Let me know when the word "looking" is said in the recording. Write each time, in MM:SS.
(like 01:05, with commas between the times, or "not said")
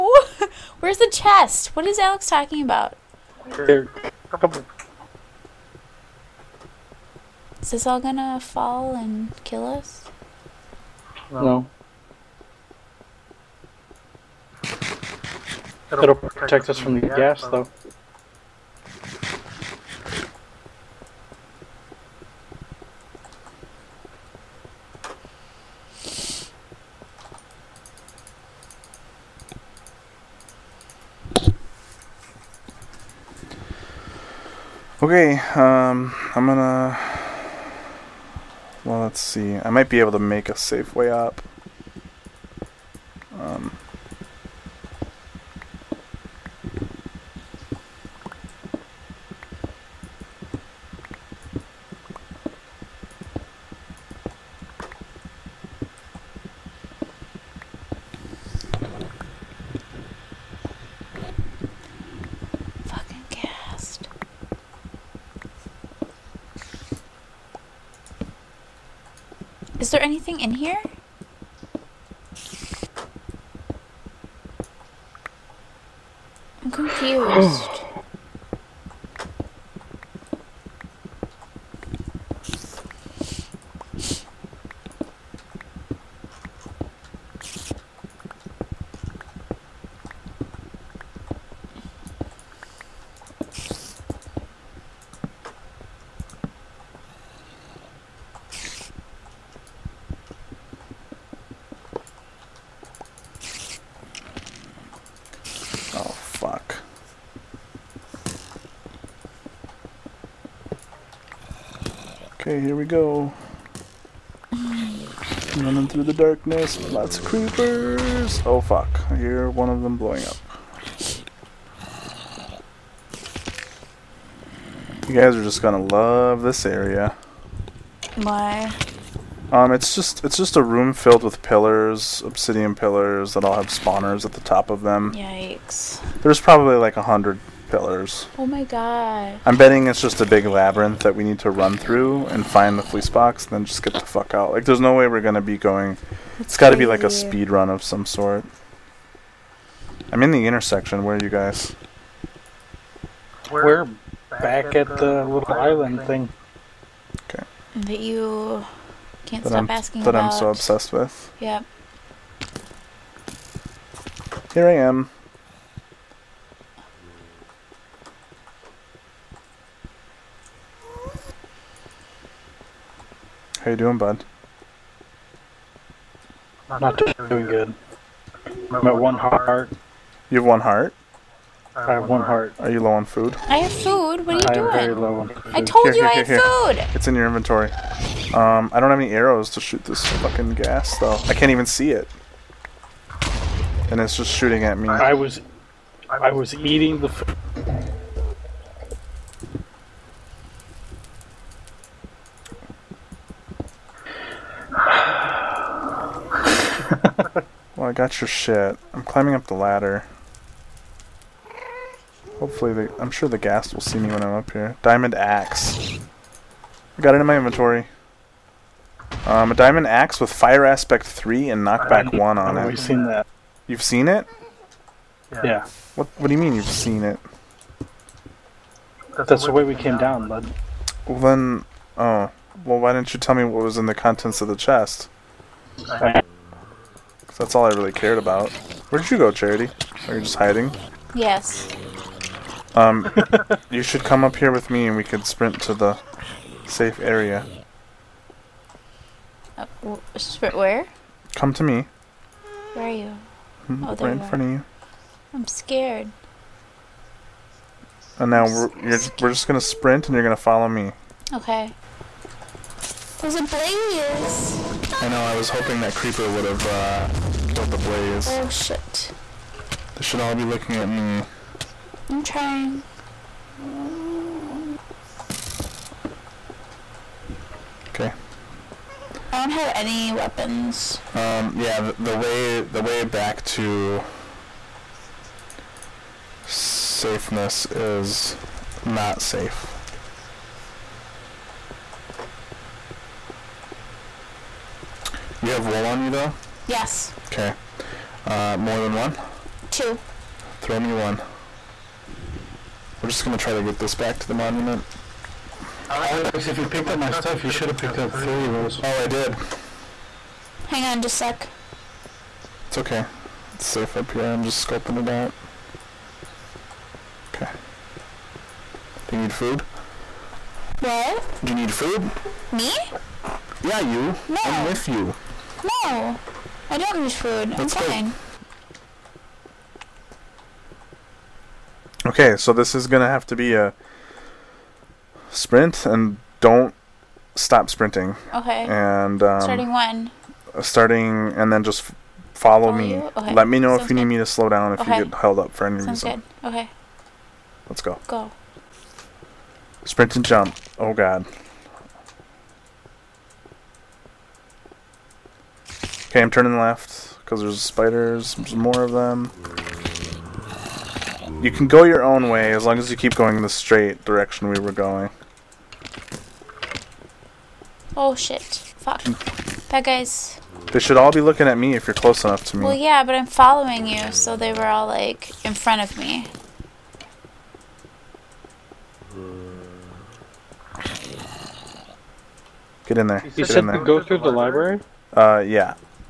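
04:30, 06:11.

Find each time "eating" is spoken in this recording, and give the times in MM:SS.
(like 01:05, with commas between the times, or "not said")
03:16.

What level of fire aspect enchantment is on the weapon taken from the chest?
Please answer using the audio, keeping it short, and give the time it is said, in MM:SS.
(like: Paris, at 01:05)
3, at 03:41.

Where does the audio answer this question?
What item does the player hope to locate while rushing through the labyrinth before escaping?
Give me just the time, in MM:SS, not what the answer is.
02:22.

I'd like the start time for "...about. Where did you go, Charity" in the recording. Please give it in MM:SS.
03:58.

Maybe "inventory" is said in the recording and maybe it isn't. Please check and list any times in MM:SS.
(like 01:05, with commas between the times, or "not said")
03:07, 03:37.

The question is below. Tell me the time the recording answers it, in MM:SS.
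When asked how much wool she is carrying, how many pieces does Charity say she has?
04:59.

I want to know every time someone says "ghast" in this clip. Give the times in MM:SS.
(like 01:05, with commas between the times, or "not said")
00:17, 03:10, 03:33.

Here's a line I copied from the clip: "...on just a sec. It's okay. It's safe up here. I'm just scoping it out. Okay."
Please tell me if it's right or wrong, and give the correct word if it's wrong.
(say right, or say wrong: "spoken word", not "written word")
right.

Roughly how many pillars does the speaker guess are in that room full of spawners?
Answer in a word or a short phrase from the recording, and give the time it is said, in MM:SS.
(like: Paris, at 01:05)
100, at 02:16.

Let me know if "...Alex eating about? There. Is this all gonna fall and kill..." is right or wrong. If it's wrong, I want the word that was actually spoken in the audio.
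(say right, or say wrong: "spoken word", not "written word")
wrong: "talking", not "eating".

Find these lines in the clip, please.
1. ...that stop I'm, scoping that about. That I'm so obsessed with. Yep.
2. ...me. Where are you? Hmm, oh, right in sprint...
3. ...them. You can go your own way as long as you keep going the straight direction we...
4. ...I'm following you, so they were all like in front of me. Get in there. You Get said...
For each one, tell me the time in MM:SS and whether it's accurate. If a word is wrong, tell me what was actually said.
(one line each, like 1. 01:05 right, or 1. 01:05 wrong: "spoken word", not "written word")
1. 02:39 wrong: "asking", not "scoping"
2. 04:11 wrong: "front", not "sprint"
3. 05:58 right
4. 06:13 right.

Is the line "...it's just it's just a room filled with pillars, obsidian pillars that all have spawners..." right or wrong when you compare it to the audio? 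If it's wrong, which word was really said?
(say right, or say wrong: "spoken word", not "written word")
right.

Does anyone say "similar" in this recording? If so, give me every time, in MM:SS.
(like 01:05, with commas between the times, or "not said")
not said.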